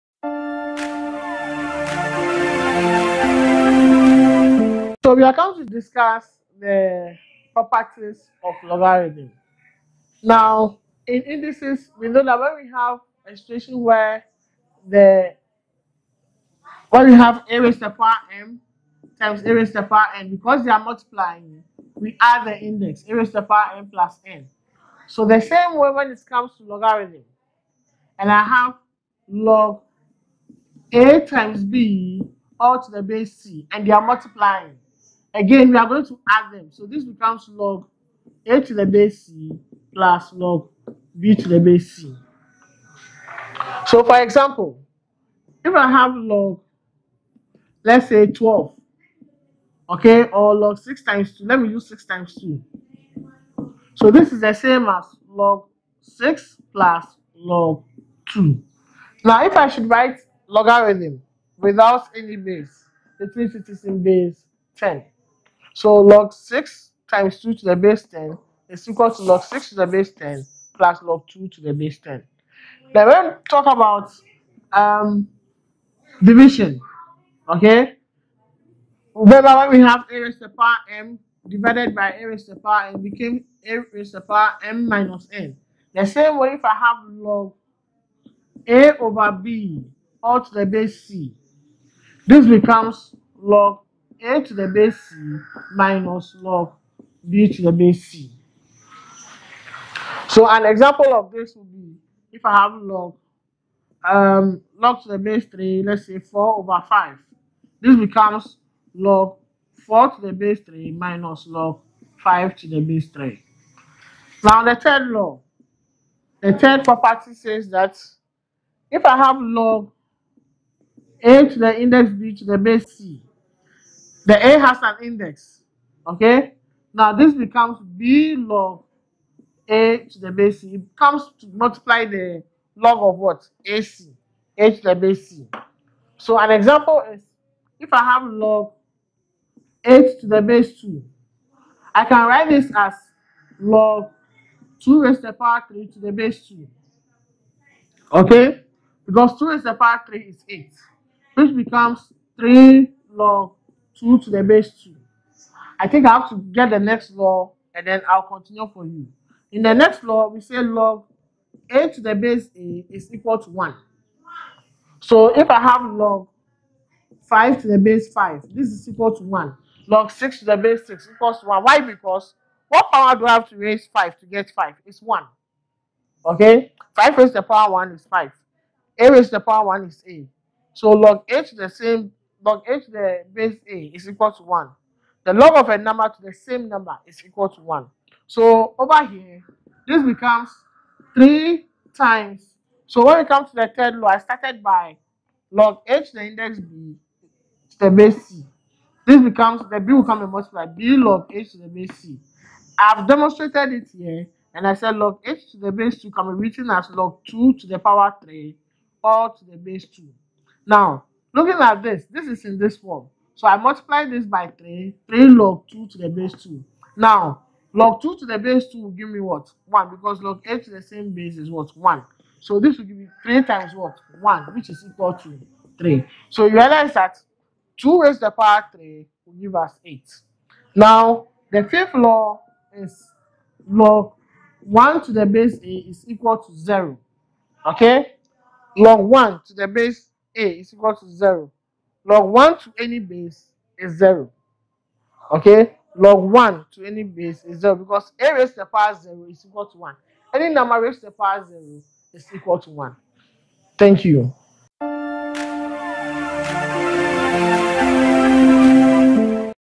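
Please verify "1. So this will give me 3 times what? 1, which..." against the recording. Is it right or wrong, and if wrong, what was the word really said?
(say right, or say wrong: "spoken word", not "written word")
right.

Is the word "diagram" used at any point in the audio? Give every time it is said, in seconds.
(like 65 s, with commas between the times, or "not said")
not said.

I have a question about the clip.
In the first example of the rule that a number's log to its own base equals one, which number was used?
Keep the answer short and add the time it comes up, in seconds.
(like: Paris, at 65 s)
5, at 165 s.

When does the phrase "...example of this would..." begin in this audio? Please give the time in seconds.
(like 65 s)
100 s.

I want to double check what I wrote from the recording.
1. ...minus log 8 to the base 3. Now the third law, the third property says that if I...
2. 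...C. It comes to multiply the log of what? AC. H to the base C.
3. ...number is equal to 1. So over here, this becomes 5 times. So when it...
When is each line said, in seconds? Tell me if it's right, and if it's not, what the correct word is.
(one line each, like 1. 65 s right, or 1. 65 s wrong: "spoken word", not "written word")
1. 110 s wrong: "5", not "8"
2. 130 s right
3. 186 s wrong: "3", not "5".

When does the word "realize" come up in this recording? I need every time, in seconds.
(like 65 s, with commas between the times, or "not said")
226 s.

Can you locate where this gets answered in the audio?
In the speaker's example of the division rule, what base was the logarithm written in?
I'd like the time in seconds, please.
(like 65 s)
105 s.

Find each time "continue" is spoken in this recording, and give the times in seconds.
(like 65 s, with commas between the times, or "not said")
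158 s.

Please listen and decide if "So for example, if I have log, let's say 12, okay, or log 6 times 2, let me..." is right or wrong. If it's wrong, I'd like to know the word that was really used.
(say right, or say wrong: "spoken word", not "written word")
right.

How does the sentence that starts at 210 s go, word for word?
Now, Looking at this, this is in this form.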